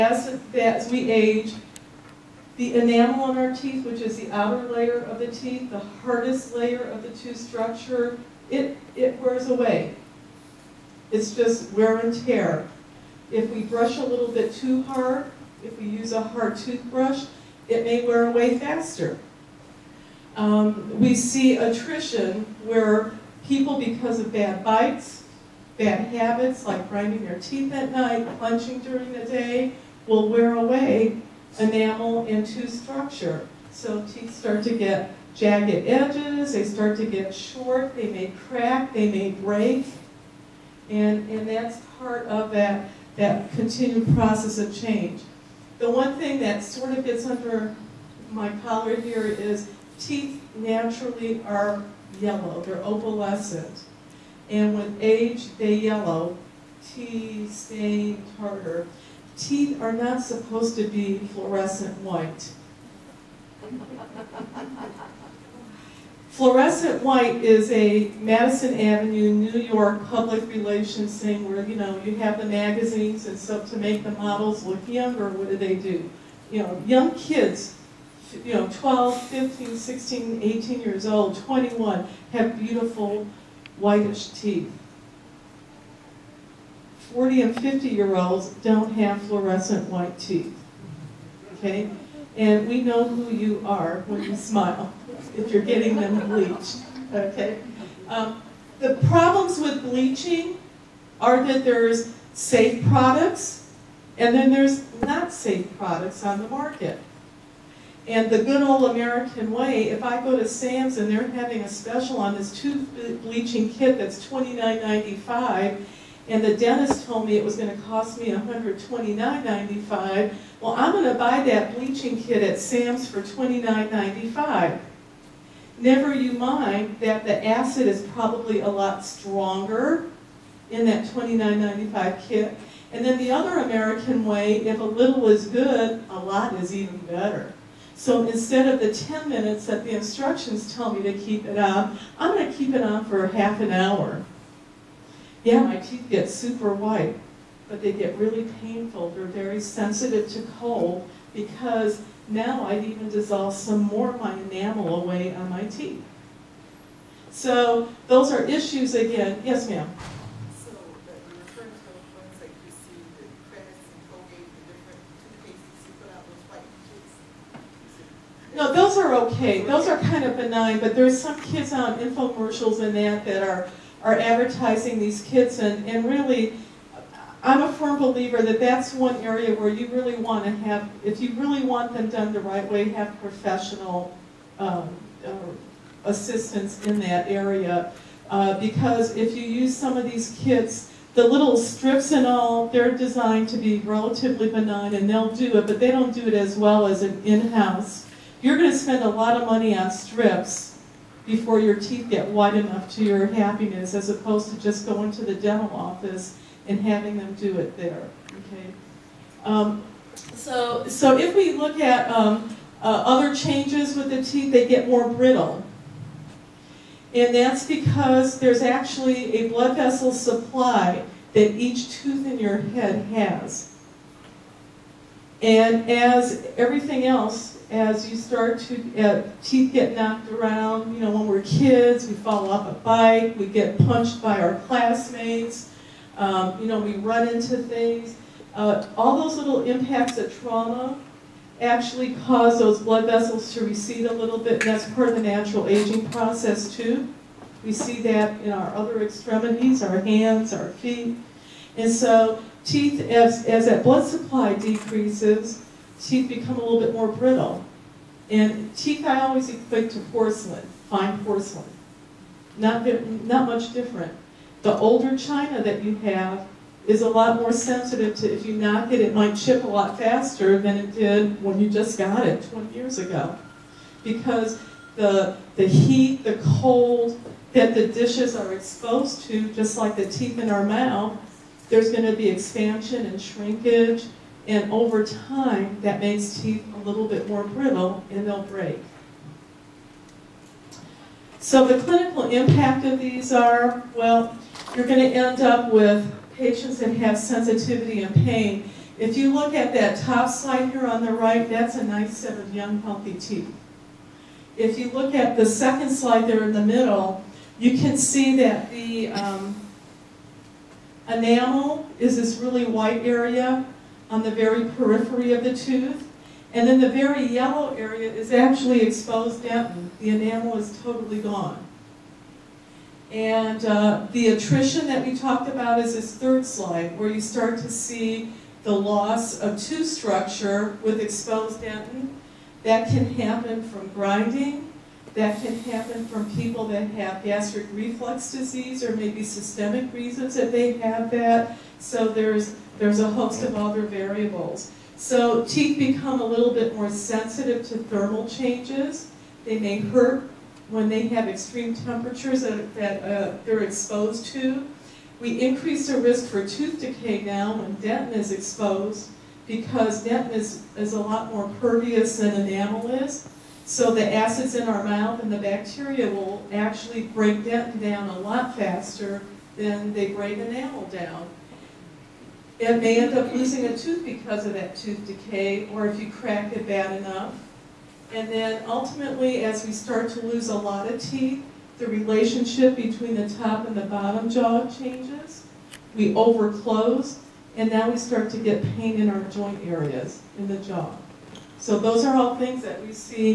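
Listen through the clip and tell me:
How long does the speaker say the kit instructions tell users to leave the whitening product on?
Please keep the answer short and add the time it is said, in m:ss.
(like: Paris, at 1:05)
10 minutes, at 2:18.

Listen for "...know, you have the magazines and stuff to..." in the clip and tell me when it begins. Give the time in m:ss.
1:11.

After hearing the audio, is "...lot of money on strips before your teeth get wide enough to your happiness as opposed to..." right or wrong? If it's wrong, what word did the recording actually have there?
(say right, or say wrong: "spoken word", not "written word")
right.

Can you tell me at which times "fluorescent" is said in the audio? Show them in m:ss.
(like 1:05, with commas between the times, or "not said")
1:01, 1:06, 1:29.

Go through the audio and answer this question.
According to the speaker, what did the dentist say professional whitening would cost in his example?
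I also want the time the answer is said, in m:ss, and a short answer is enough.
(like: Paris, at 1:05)
$129.95, at 1:58.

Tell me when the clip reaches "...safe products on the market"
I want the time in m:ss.
1:45.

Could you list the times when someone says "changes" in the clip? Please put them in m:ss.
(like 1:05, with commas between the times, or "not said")
0:44, 3:33, 5:48, 6:24.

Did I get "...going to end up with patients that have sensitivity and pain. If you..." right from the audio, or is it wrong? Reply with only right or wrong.
right.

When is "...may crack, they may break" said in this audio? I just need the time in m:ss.
0:38.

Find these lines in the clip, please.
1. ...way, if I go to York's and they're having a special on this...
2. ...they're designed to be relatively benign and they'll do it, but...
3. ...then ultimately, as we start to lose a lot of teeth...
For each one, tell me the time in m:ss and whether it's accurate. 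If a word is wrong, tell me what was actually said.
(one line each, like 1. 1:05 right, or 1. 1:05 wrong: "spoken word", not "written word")
1. 1:49 wrong: "Sam", not "York"
2. 3:12 right
3. 6:18 right.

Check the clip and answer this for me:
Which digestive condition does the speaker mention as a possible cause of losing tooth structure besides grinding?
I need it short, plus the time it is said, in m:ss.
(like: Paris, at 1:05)
gastric reflux disease, at 5:37.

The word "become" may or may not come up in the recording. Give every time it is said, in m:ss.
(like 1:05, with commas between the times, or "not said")
4:16, 5:45.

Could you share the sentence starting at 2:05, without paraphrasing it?
Never you mind that the acid is probably a lot stronger in that $29.95 kit.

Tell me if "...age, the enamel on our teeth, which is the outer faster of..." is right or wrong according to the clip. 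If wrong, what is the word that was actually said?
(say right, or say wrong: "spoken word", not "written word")
wrong: "layer", not "faster".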